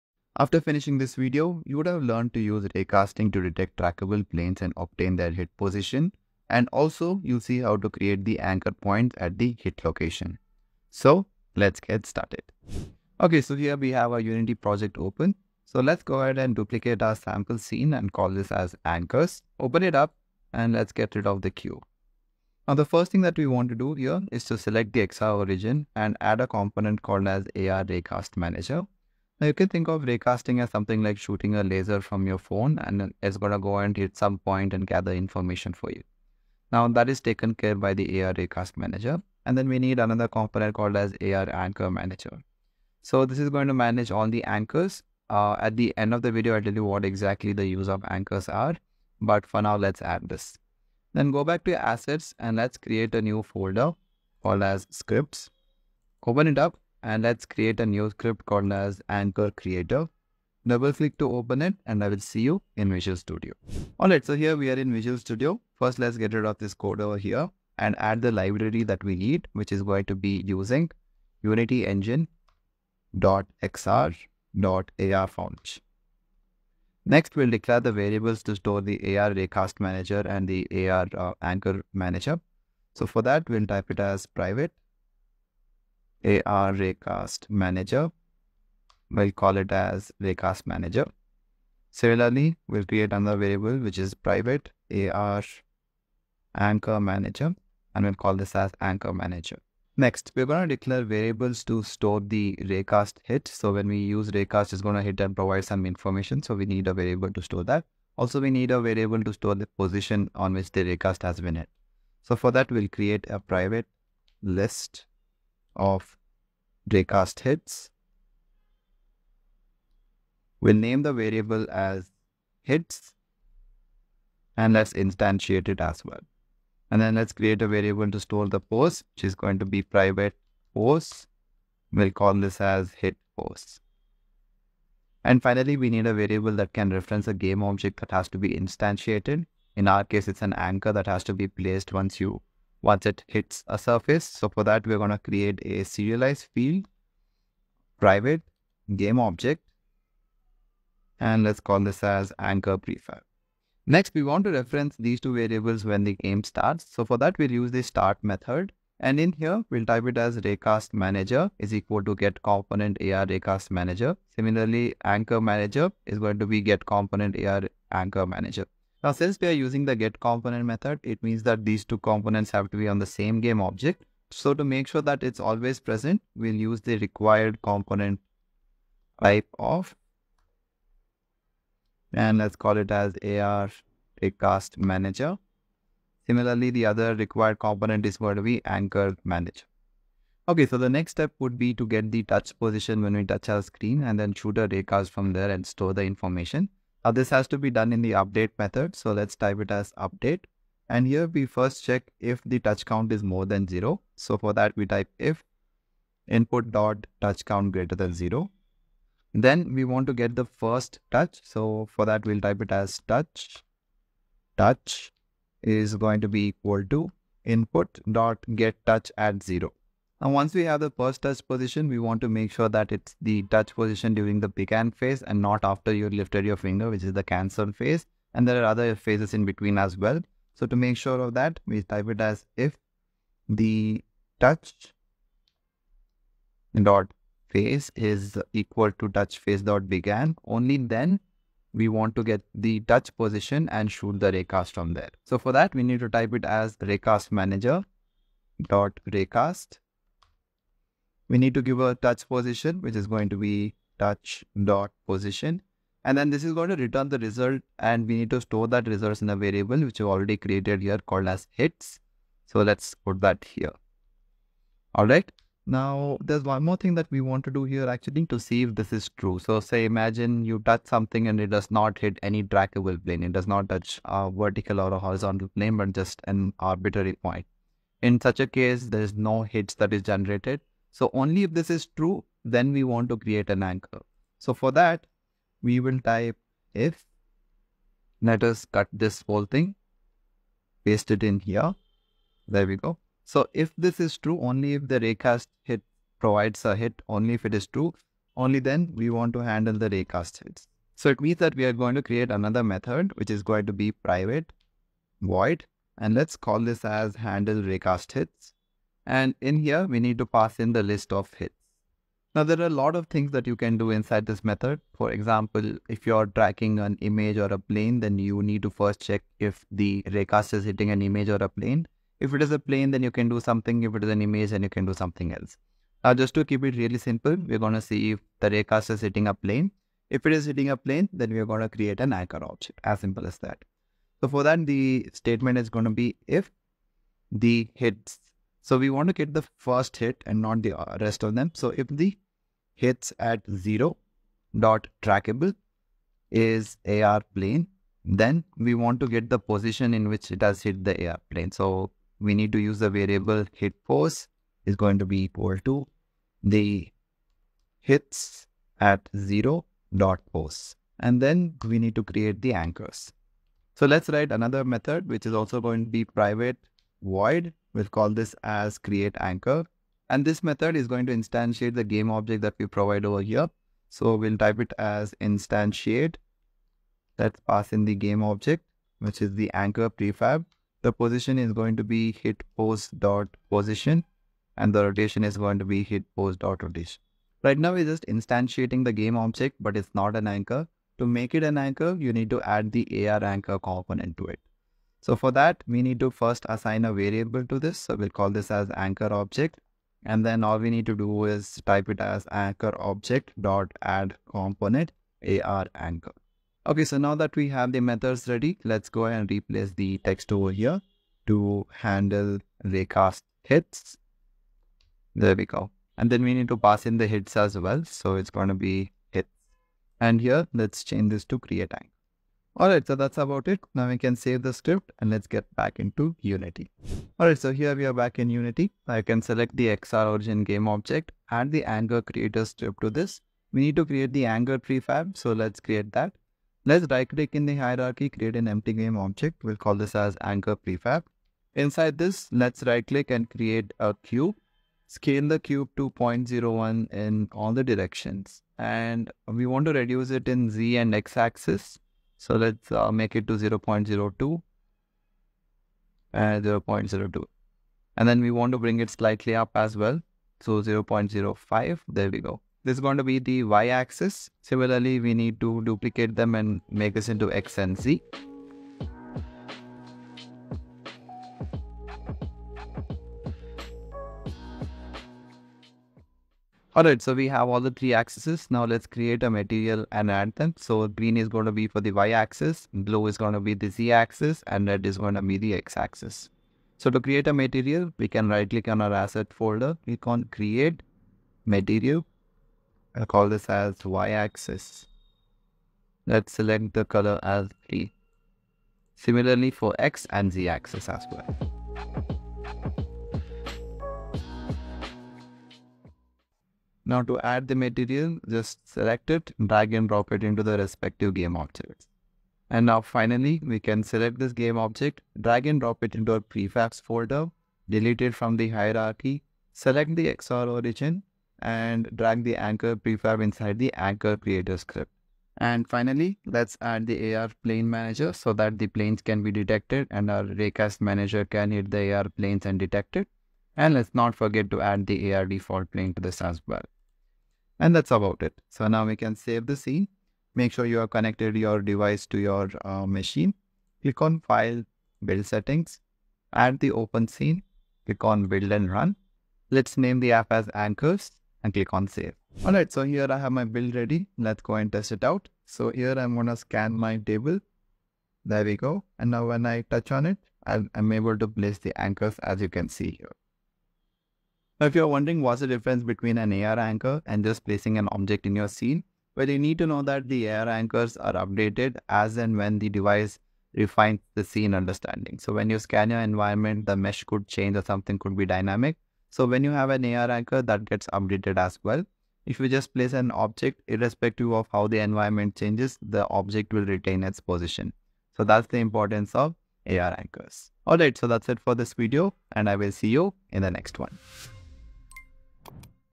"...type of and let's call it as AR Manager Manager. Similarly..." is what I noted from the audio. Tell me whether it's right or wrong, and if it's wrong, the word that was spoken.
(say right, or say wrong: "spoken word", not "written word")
wrong: "Raycast", not "Manager".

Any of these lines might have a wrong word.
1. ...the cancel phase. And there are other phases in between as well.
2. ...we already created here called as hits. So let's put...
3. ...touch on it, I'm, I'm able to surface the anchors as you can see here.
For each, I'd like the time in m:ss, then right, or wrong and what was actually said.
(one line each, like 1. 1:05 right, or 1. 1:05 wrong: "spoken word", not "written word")
1. 3:47 right
2. 4:19 right
3. 9:19 wrong: "place", not "surface".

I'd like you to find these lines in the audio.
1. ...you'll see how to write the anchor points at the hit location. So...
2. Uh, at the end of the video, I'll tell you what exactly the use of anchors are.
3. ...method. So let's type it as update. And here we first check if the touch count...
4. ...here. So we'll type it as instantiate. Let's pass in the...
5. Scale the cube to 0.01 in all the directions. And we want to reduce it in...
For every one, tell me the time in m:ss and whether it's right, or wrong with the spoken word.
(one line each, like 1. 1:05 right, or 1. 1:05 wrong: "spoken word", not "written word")
1. 0:07 wrong: "create", not "write"
2. 0:45 right
3. 3:18 right
4. 6:13 right
5. 7:24 right.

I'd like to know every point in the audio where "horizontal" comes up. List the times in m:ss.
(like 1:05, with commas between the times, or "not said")
4:34.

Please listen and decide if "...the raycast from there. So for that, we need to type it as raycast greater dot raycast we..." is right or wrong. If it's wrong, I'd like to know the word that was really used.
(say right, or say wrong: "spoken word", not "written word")
wrong: "manager", not "greater".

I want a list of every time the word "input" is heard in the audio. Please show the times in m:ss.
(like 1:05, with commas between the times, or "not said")
3:26, 3:37.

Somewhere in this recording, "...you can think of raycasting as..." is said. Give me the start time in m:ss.
0:29.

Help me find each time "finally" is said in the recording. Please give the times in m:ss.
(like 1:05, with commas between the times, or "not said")
2:15, 8:32, 8:45.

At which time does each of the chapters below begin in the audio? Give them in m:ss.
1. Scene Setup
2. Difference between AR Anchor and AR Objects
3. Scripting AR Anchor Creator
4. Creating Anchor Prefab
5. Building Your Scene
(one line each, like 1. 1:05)
1. 0:21
2. 9:24
3. 0:58
4. 7:13
5. 9:00.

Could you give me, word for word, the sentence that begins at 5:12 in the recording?
Now, there are a lot of things that you can do inside this method.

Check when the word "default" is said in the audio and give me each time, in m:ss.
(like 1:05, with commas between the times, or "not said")
8:55.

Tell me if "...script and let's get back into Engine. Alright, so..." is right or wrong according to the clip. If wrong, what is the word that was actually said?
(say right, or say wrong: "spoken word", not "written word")
wrong: "Unity", not "Engine".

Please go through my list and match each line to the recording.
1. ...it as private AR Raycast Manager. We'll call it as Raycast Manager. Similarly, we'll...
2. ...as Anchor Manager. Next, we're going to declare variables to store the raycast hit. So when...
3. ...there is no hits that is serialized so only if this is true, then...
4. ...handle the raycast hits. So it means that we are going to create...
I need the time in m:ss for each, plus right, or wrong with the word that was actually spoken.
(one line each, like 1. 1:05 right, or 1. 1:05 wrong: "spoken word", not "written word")
1. 1:23 right
2. 1:38 right
3. 4:38 wrong: "generated", not "serialized"
4. 4:59 right.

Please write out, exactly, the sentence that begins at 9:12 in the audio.
All right, so here I have my build ready.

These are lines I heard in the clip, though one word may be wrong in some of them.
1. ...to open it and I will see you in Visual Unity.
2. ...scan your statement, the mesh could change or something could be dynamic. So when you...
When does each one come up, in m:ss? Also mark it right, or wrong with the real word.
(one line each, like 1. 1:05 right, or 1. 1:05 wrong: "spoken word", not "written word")
1. 1:01 wrong: "Studio", not "Unity"
2. 9:35 wrong: "environment", not "statement".